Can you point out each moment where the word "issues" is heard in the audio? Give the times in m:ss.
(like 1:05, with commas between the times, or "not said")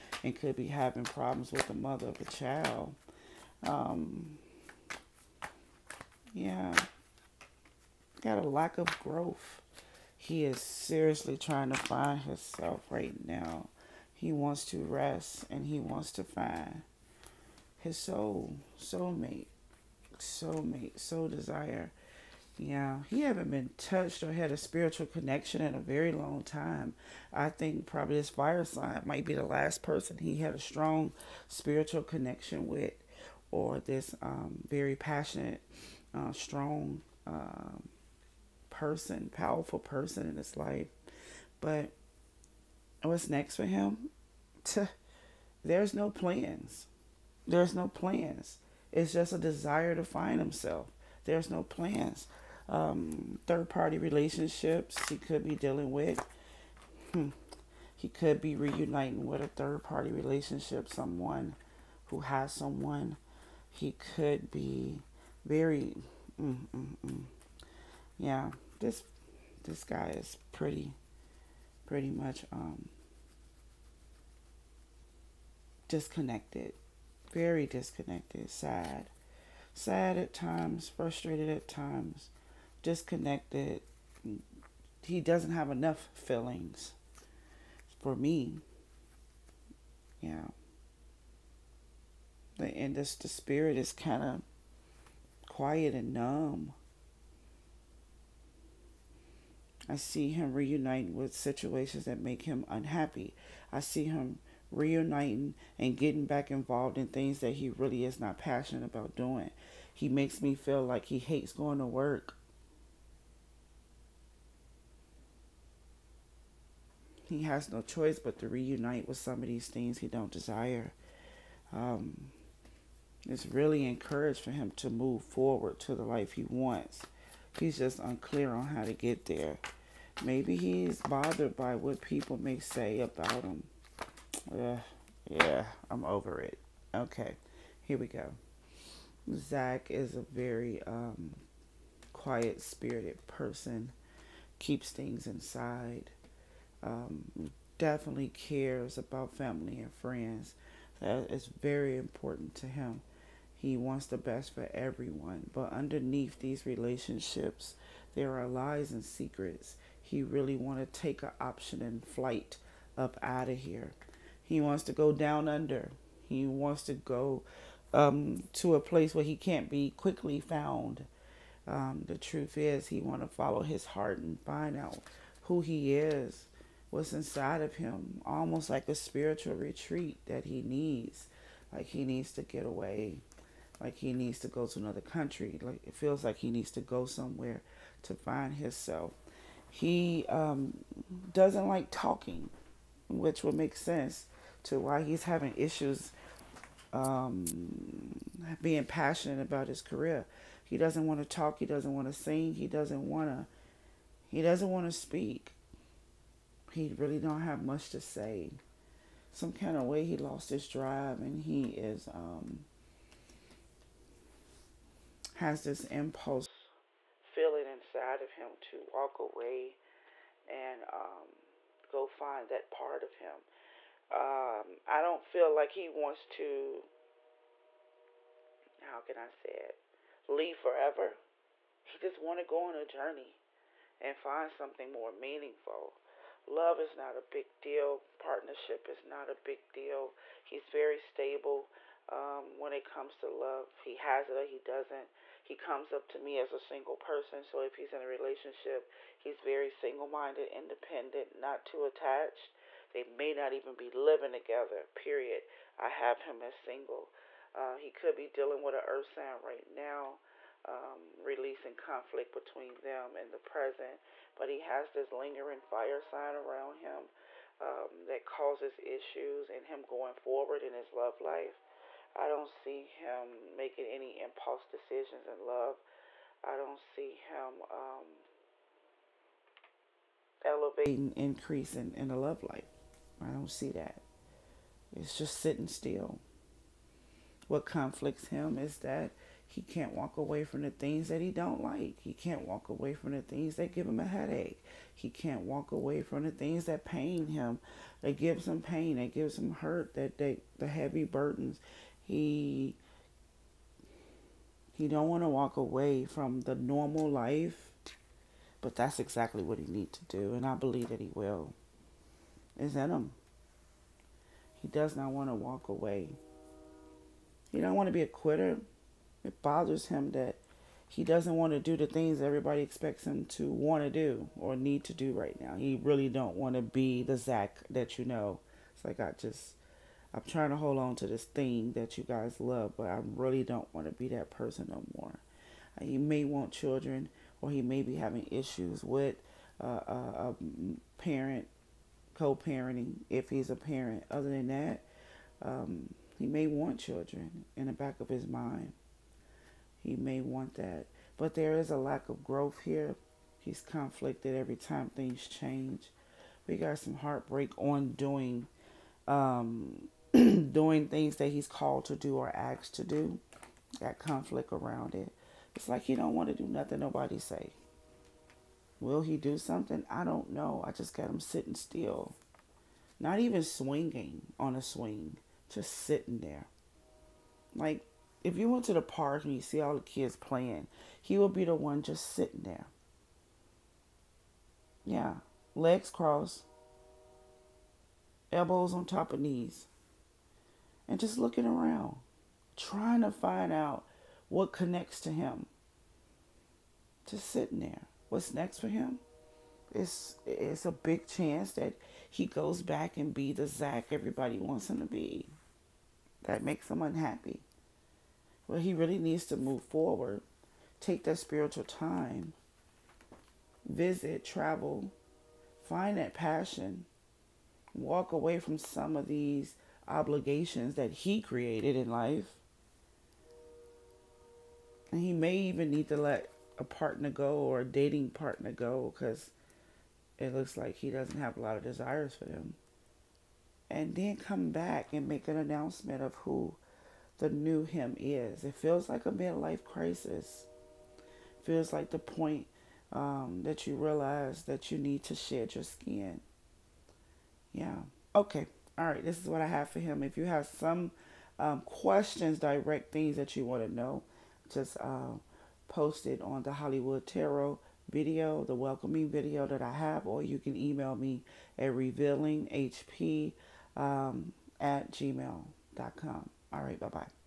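3:15, 4:28, 5:38.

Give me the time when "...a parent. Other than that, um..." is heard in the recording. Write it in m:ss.
5:43.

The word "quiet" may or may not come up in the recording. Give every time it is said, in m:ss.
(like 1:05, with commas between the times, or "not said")
1:35, 2:22.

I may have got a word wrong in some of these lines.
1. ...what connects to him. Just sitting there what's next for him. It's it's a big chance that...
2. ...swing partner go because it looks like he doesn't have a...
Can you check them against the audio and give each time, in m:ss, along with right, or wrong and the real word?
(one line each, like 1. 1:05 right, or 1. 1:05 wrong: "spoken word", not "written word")
1. 6:34 right
2. 7:07 wrong: "dating", not "swing".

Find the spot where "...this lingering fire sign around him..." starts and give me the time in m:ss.
4:24.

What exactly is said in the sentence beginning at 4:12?
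They may not even be living together, period.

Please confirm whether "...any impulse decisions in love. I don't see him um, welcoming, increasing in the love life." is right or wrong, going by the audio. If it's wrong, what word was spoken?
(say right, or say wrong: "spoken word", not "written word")
wrong: "elevating", not "welcoming".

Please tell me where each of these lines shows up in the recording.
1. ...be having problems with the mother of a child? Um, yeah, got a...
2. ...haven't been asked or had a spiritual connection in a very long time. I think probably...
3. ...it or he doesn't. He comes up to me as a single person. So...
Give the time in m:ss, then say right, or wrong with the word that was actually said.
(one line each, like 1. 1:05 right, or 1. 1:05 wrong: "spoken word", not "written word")
1. 0:00 right
2. 0:23 wrong: "touched", not "asked"
3. 4:04 right.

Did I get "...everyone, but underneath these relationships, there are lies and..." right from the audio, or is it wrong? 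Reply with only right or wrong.
right.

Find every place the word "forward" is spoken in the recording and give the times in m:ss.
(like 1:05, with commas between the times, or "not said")
2:05, 4:30, 6:49.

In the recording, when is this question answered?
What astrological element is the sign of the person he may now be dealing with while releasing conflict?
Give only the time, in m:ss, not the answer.
4:18.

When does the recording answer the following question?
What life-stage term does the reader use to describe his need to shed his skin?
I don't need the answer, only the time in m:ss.
7:19.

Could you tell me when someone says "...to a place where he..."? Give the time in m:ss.
2:48.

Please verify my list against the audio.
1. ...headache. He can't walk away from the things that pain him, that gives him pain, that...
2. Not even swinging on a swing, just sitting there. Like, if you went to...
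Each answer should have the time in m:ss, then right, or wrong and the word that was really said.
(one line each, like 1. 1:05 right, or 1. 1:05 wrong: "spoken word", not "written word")
1. 4:54 right
2. 6:12 right.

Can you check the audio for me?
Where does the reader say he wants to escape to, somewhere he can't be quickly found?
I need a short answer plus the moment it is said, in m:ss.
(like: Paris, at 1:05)
Down under, at 2:45.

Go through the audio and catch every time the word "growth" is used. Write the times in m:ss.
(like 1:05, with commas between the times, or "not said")
0:09, 5:52.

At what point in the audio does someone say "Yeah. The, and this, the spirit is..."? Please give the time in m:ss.
1:30.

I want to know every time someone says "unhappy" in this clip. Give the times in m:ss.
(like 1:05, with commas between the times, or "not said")
1:42, 6:46.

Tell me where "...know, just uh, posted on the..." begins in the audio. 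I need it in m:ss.
7:33.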